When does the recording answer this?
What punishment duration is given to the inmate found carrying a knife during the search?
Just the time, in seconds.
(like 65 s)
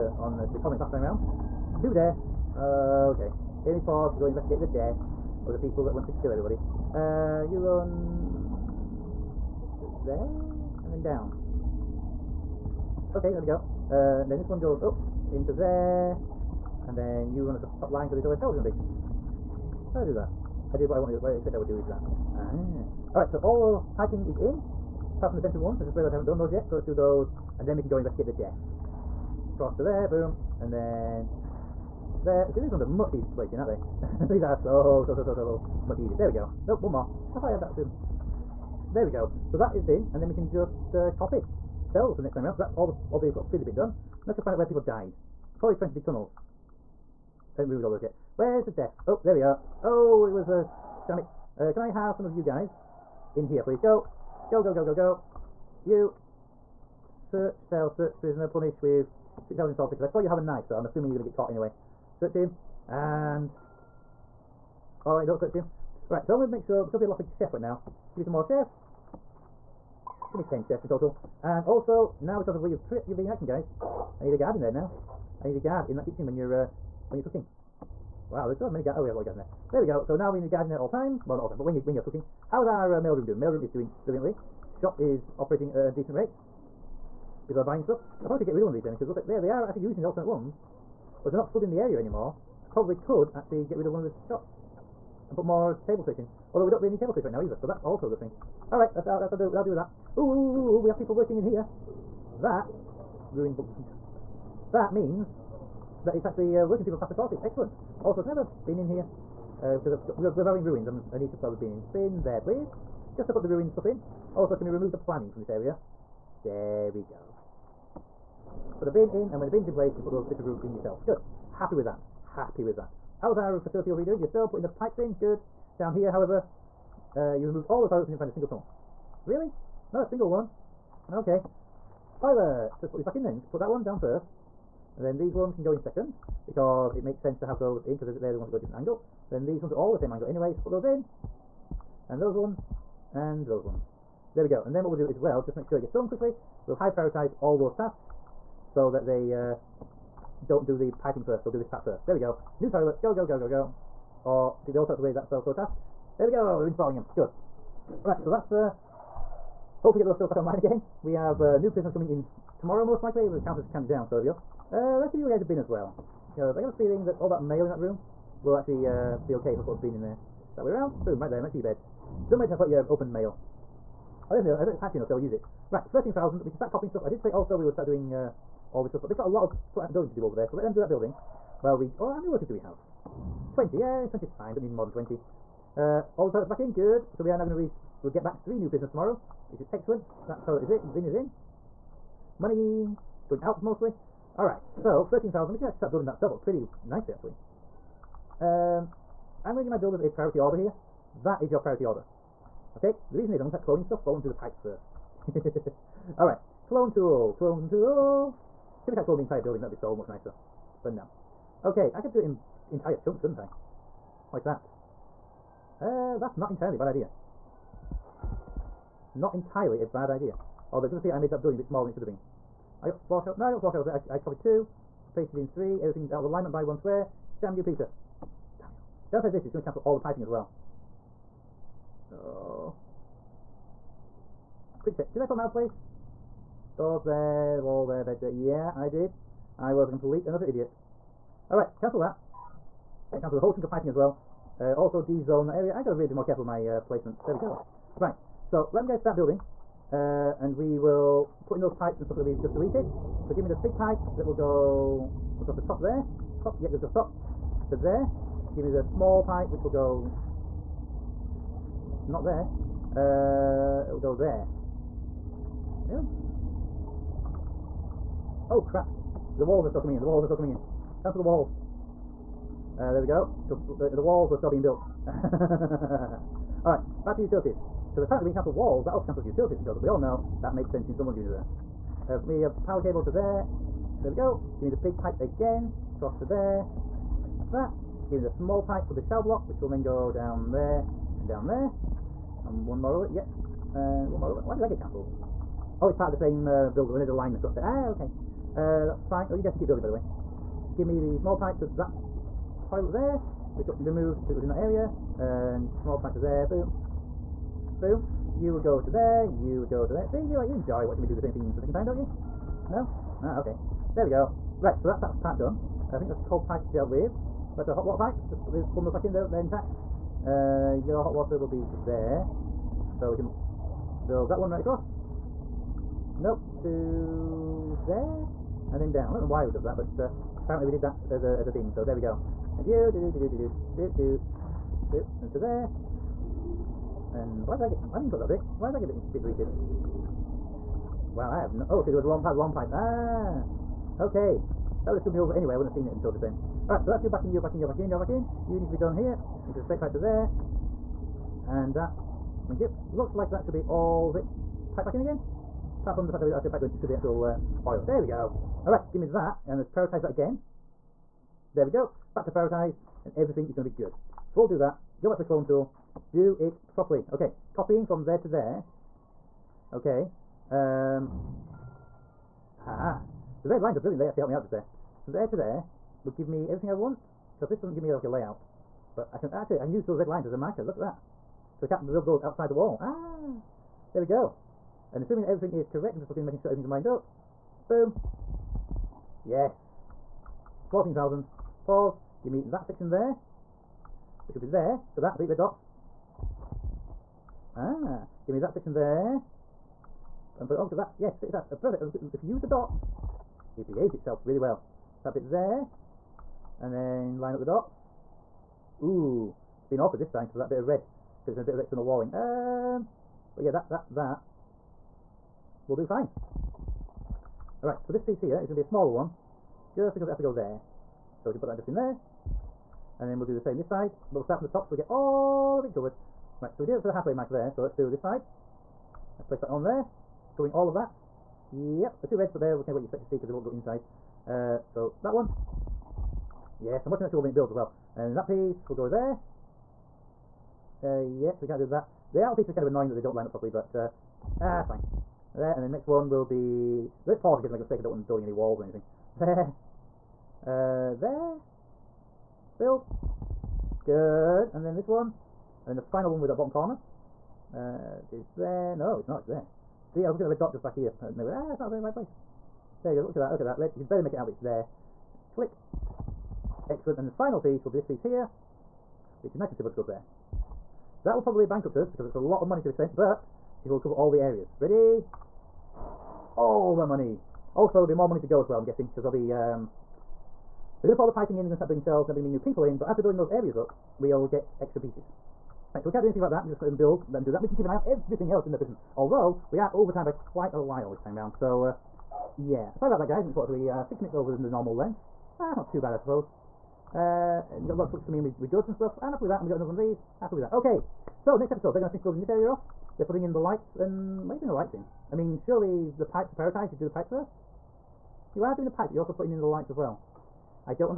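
59 s.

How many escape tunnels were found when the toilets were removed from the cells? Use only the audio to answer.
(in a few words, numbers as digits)
0.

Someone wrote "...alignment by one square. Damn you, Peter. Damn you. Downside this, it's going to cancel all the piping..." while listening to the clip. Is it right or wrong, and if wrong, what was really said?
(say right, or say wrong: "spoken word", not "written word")
right.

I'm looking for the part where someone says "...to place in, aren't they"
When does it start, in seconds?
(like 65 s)
33 s.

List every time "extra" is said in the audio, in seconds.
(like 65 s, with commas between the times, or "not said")
484 s.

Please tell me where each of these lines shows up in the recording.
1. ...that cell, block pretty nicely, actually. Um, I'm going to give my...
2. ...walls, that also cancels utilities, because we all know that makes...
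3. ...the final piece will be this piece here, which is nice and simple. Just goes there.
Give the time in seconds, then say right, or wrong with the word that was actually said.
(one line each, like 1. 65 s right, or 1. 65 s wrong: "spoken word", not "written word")
1. 196 s right
2. 278 s right
3. 467 s right.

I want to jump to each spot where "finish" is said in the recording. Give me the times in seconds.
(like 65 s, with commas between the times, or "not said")
501 s.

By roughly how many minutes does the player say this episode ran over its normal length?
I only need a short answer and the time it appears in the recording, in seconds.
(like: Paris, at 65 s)
6, at 493 s.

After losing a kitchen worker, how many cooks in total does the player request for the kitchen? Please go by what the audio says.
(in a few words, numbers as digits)
10.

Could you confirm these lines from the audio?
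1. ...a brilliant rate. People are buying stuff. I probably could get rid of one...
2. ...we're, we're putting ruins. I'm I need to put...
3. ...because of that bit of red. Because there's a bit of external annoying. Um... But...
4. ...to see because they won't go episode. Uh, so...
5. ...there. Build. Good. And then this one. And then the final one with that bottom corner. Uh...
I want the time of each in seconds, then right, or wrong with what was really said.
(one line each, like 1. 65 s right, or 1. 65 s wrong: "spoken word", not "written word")
1. 85 s wrong: "decent", not "brilliant"
2. 110 s wrong: "having", not "putting"
3. 410 s wrong: "walling", not "annoying"
4. 432 s wrong: "inside", not "episode"
5. 450 s right.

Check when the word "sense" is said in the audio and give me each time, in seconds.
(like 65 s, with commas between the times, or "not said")
137 s, 280 s.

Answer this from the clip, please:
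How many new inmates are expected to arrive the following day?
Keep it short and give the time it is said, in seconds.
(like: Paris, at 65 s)
3, at 188 s.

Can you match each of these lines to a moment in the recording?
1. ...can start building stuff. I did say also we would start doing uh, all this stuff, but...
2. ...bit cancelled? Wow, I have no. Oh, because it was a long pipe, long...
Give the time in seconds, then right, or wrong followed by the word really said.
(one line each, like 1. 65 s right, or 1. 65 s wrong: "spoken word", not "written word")
1. 176 s wrong: "copying", not "building"
2. 339 s wrong: "deleted", not "cancelled".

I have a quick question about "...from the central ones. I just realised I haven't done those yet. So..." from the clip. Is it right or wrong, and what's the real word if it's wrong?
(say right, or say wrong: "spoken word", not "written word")
right.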